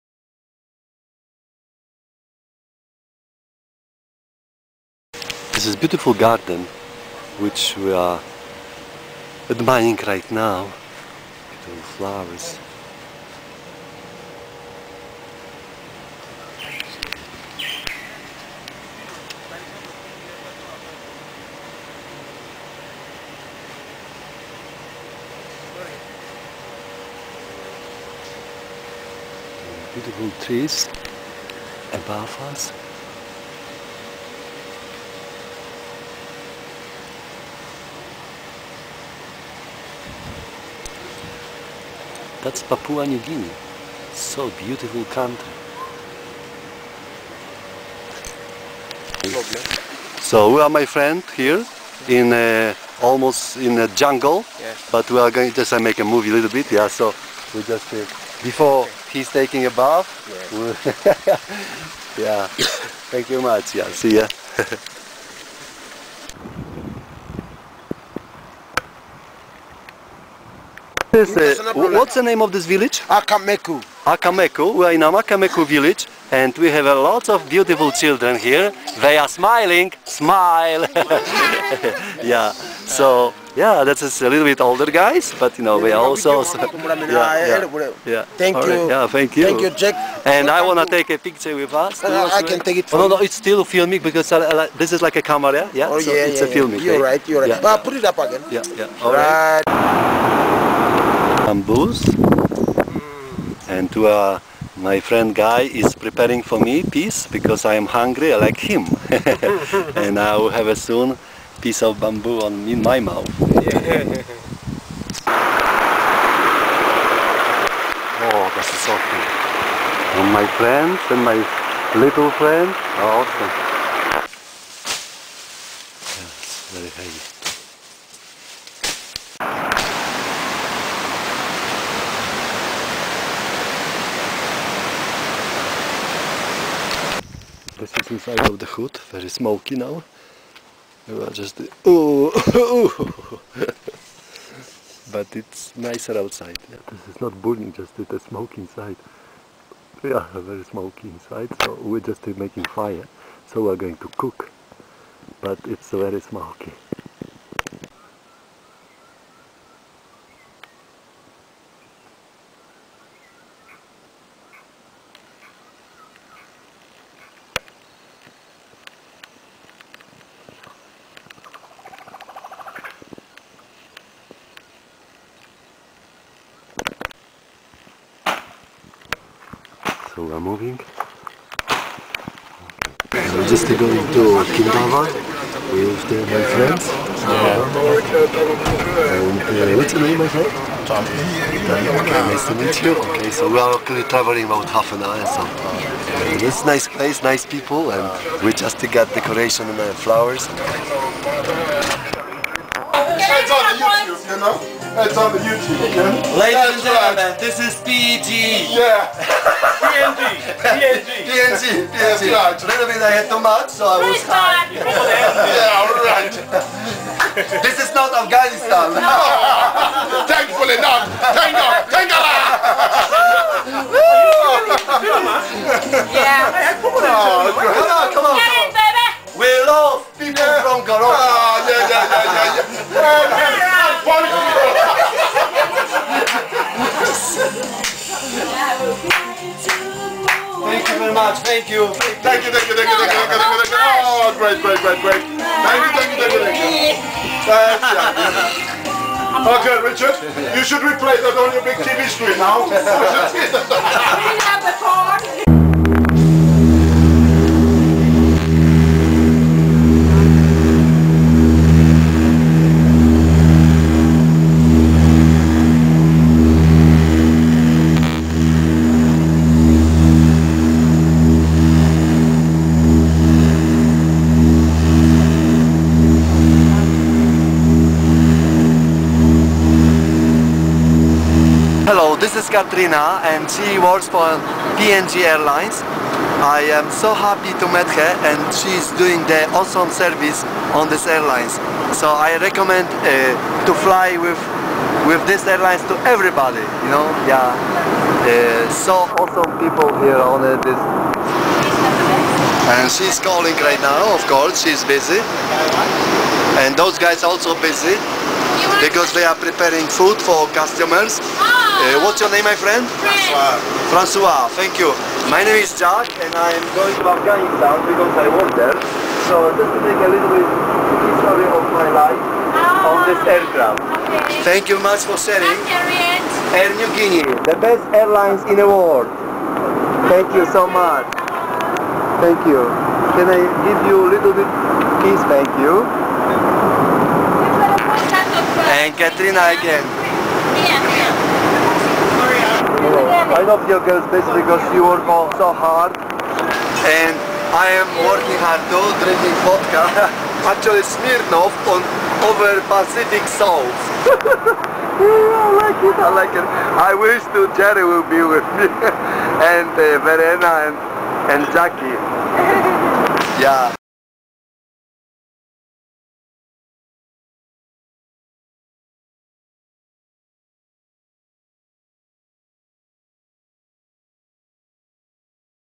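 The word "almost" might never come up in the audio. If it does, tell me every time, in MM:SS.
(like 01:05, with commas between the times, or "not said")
00:53.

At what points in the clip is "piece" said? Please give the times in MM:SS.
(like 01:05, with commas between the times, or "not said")
01:46, 01:51.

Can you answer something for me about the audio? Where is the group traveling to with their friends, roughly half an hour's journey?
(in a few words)
Kindava.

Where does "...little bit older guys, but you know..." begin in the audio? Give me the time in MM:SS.
01:24.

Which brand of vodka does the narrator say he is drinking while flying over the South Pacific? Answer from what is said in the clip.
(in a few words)
Smirnoff.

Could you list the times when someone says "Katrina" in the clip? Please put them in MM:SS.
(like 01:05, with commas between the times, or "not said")
04:42, 05:38.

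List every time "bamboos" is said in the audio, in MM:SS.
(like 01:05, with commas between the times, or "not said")
01:41, 01:51.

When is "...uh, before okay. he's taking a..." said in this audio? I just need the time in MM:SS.
00:57.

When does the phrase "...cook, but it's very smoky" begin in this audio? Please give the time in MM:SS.
02:34.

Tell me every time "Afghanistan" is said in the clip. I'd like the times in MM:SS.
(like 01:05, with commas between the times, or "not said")
03:38, 05:17.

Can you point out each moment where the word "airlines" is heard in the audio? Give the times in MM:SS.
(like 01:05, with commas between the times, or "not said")
04:45, 04:51, 04:55, 05:27.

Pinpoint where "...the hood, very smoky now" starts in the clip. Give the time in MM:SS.
02:18.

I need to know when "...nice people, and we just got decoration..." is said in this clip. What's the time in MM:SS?
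03:17.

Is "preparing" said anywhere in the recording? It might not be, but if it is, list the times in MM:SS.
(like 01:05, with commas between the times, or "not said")
01:46, 05:09.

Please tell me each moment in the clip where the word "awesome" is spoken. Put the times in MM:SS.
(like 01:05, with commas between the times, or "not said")
02:03, 04:49, 04:59.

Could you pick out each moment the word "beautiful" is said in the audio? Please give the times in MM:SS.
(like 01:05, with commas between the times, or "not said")
00:05, 00:11, 00:29, 00:44, 01:17.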